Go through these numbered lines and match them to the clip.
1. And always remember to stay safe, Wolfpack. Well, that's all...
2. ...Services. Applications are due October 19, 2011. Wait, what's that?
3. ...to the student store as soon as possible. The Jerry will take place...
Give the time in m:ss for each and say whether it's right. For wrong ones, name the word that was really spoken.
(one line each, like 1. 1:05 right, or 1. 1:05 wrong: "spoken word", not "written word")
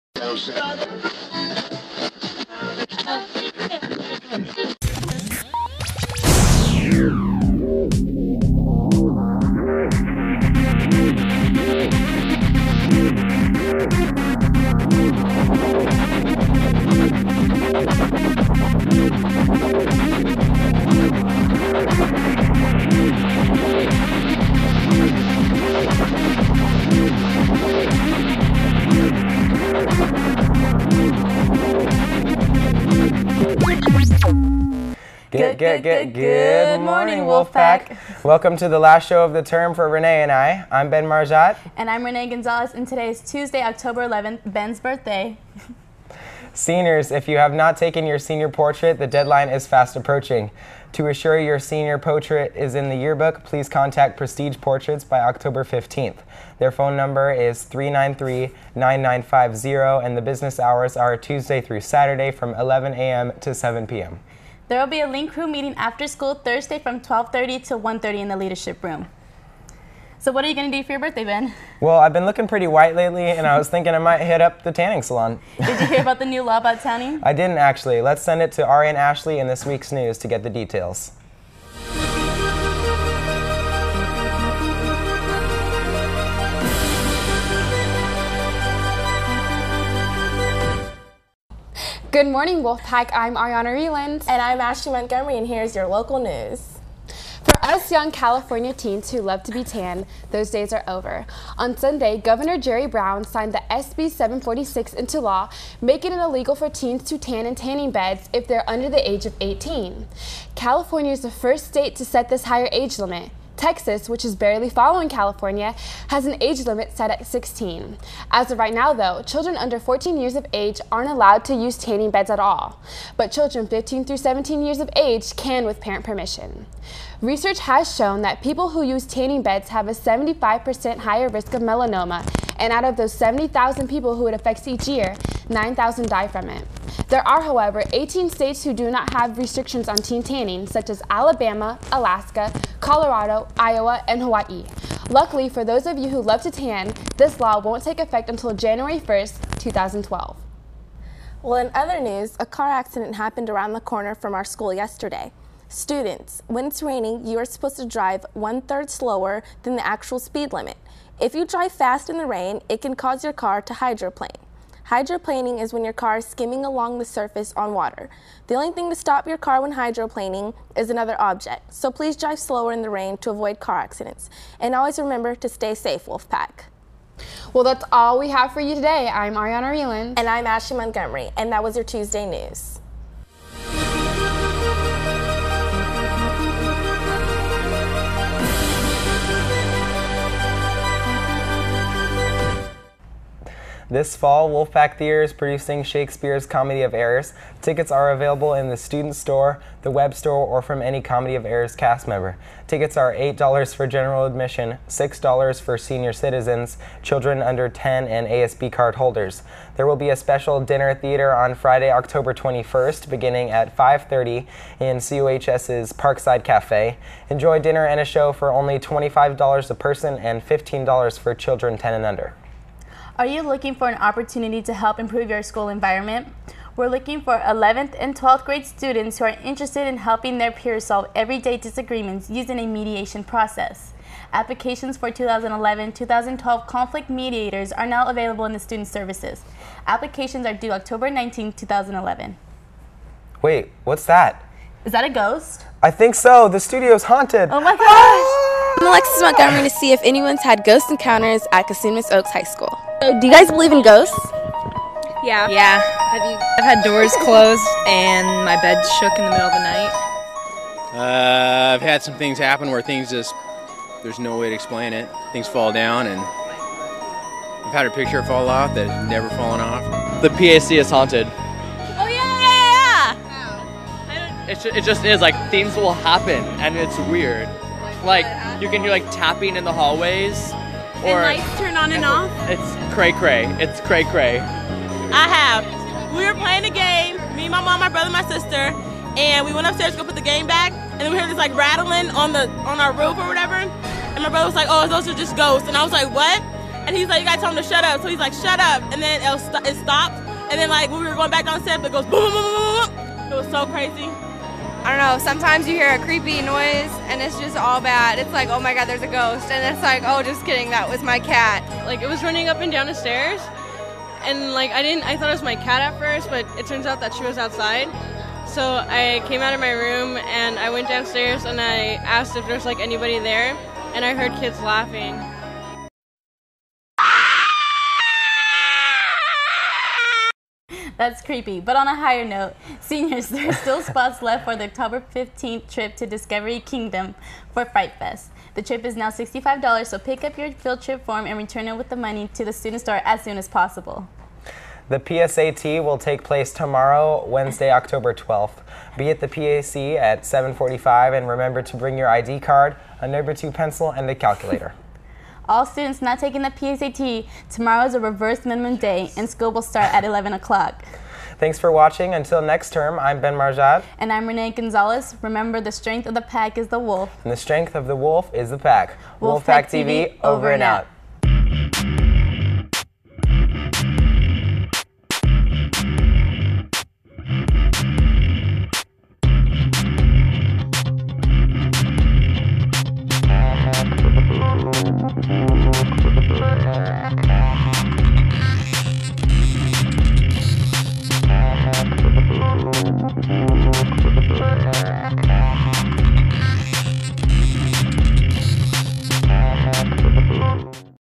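1. 2:54 right
2. 3:58 right
3. 5:42 wrong: "PSAT", not "Jerry".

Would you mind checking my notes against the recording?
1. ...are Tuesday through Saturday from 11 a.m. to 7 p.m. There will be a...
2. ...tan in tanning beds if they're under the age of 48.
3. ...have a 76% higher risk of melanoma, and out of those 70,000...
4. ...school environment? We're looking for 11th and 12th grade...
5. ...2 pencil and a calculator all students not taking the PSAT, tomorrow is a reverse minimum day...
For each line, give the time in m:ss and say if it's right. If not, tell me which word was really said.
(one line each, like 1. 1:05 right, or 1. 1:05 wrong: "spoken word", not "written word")
1. 1:00 right
2. 1:47 wrong: "18", not "48"
3. 2:09 wrong: "75", not "76"
4. 3:45 right
5. 5:53 right.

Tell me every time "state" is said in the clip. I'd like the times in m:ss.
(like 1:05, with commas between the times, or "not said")
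1:51, 2:18.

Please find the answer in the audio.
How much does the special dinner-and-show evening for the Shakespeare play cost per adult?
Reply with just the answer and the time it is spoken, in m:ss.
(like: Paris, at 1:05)
$25, at 3:38.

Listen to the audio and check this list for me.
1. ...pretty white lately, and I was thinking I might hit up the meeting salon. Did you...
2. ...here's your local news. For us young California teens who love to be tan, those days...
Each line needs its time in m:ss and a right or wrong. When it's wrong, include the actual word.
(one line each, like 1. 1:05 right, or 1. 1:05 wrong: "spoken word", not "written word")
1. 1:12 wrong: "tanning", not "meeting"
2. 1:35 right.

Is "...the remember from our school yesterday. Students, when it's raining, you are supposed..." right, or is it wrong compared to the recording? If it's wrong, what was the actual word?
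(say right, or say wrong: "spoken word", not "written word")
wrong: "corner", not "remember".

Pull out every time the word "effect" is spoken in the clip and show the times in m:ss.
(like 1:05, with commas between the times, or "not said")
2:27.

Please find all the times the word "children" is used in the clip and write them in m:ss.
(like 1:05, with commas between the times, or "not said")
1:59, 2:03, 3:27, 3:41.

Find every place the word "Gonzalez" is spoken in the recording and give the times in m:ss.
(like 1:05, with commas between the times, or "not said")
0:42, 6:04.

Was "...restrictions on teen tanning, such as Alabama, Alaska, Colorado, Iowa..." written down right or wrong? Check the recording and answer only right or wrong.
right.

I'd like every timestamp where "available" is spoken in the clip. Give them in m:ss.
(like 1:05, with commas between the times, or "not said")
3:18, 3:58.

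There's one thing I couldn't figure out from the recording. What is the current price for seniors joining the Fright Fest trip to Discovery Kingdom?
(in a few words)
$65.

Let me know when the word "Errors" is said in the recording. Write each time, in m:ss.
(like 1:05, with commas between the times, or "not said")
3:16, 3:21.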